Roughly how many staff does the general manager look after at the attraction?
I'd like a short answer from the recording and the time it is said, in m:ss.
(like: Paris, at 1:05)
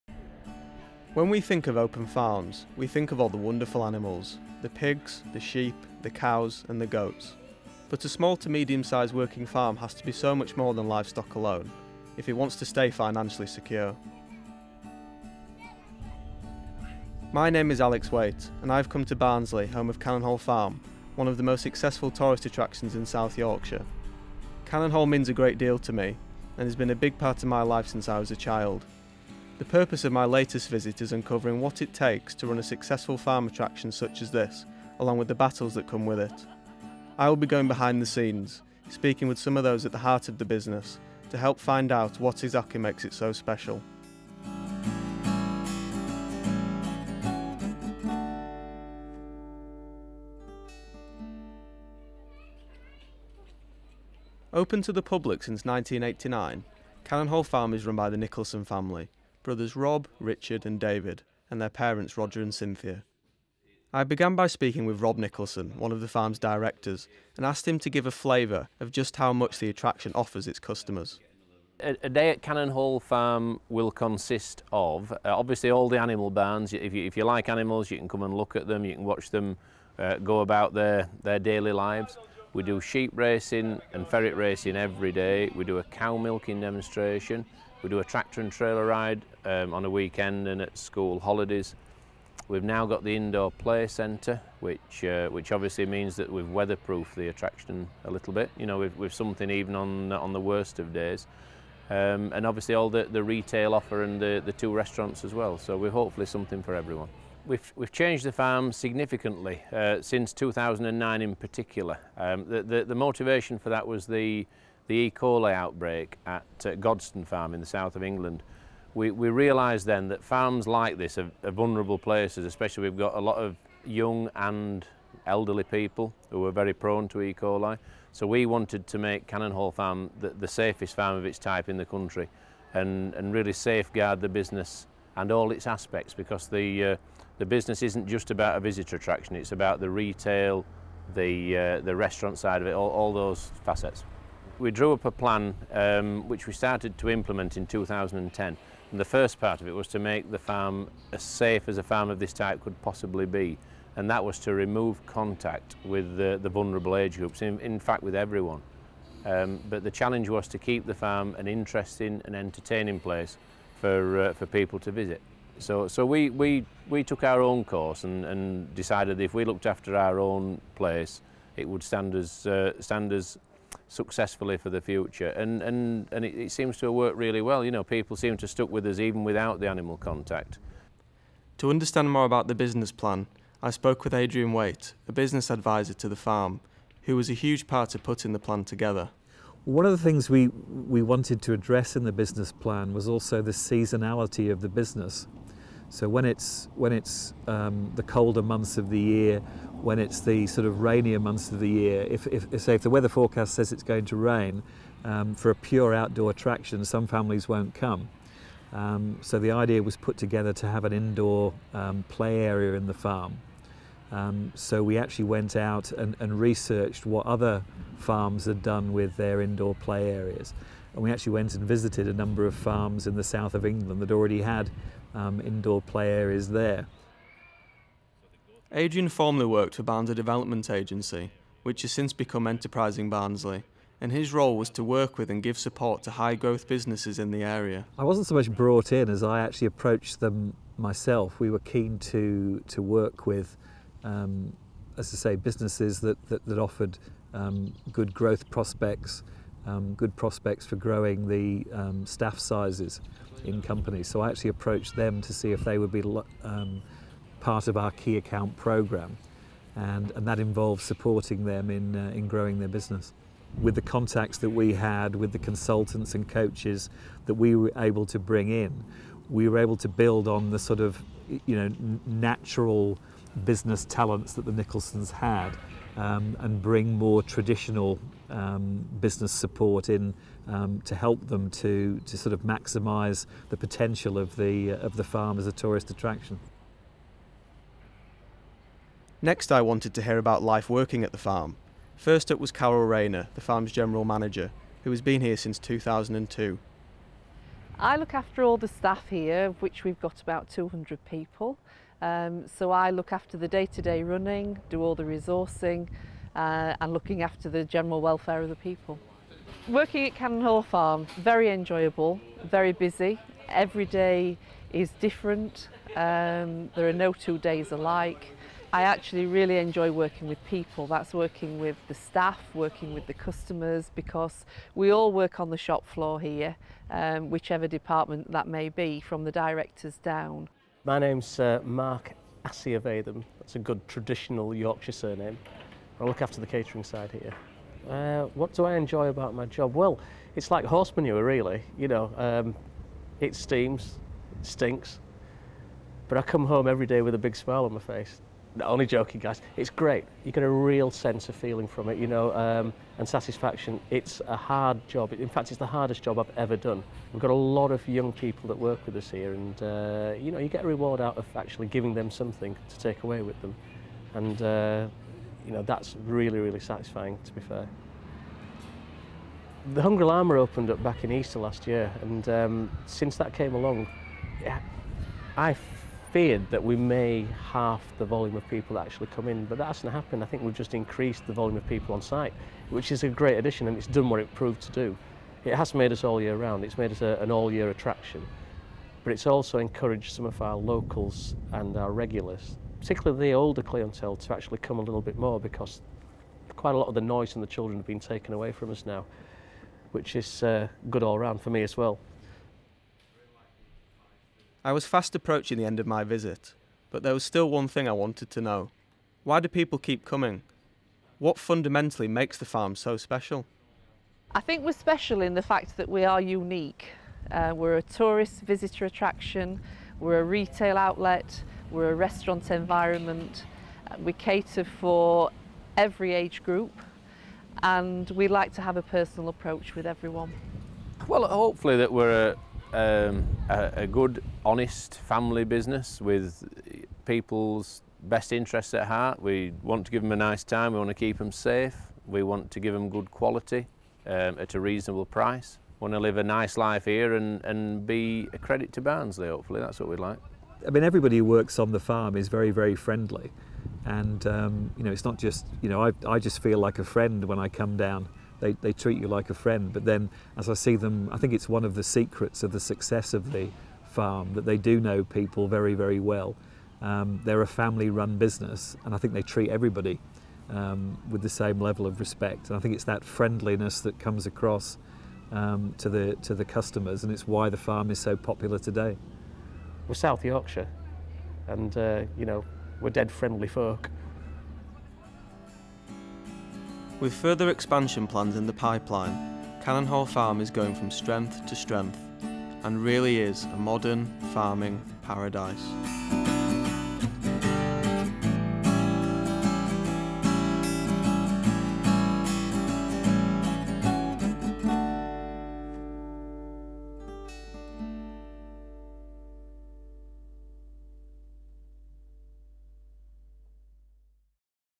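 200, at 5:00.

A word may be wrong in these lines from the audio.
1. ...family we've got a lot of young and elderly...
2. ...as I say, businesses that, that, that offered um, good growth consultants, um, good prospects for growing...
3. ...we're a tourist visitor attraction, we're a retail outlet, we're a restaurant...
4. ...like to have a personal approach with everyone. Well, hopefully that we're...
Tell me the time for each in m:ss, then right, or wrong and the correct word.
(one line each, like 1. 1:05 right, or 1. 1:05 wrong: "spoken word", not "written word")
1. 2:02 wrong: "especially", not "family"
2. 4:04 wrong: "prospects", not "consultants"
3. 6:57 right
4. 7:08 right.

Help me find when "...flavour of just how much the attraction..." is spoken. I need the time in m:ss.
1:08.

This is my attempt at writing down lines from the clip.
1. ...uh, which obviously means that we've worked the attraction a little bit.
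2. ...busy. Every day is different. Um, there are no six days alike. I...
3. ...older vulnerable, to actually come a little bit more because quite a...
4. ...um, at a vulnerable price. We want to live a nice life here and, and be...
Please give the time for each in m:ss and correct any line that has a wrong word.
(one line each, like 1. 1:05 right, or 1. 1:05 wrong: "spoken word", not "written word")
1. 1:35 wrong: "weatherproofed", not "worked"
2. 5:12 wrong: "two", not "six"
3. 6:33 wrong: "clientele", not "vulnerable"
4. 7:24 wrong: "reasonable", not "vulnerable".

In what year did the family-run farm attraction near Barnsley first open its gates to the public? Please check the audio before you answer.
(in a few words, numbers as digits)
1989.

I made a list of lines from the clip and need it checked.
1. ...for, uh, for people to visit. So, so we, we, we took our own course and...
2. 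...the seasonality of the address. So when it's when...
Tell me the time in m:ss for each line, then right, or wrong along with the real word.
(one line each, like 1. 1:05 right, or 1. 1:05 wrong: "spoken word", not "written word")
1. 2:43 right
2. 3:13 wrong: "business", not "address".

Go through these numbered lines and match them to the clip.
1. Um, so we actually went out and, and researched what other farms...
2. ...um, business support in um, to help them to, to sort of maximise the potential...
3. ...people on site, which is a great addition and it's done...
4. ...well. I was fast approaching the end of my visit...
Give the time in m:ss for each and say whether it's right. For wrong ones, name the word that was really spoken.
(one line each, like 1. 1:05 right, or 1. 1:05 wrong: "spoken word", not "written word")
1. 3:34 right
2. 4:38 right
3. 6:21 right
4. 6:41 right.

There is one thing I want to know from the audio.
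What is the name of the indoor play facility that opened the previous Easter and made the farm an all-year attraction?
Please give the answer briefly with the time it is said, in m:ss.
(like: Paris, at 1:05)
The Hungry Llama, at 6:09.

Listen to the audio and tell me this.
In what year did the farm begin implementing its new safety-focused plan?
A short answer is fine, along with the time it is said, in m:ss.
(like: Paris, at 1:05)
2010, at 2:27.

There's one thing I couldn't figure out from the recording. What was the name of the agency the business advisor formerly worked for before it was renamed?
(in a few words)
Barnsley Development Agency.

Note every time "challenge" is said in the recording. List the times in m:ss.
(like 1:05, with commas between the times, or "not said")
2:39.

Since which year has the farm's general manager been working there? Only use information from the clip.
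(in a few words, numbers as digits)
2002.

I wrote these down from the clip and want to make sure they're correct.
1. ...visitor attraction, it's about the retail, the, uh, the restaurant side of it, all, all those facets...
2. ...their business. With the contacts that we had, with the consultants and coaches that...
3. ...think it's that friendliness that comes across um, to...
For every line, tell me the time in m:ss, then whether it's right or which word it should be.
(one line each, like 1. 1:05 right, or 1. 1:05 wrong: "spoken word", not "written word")
1. 2:18 right
2. 4:22 right
3. 7:52 right.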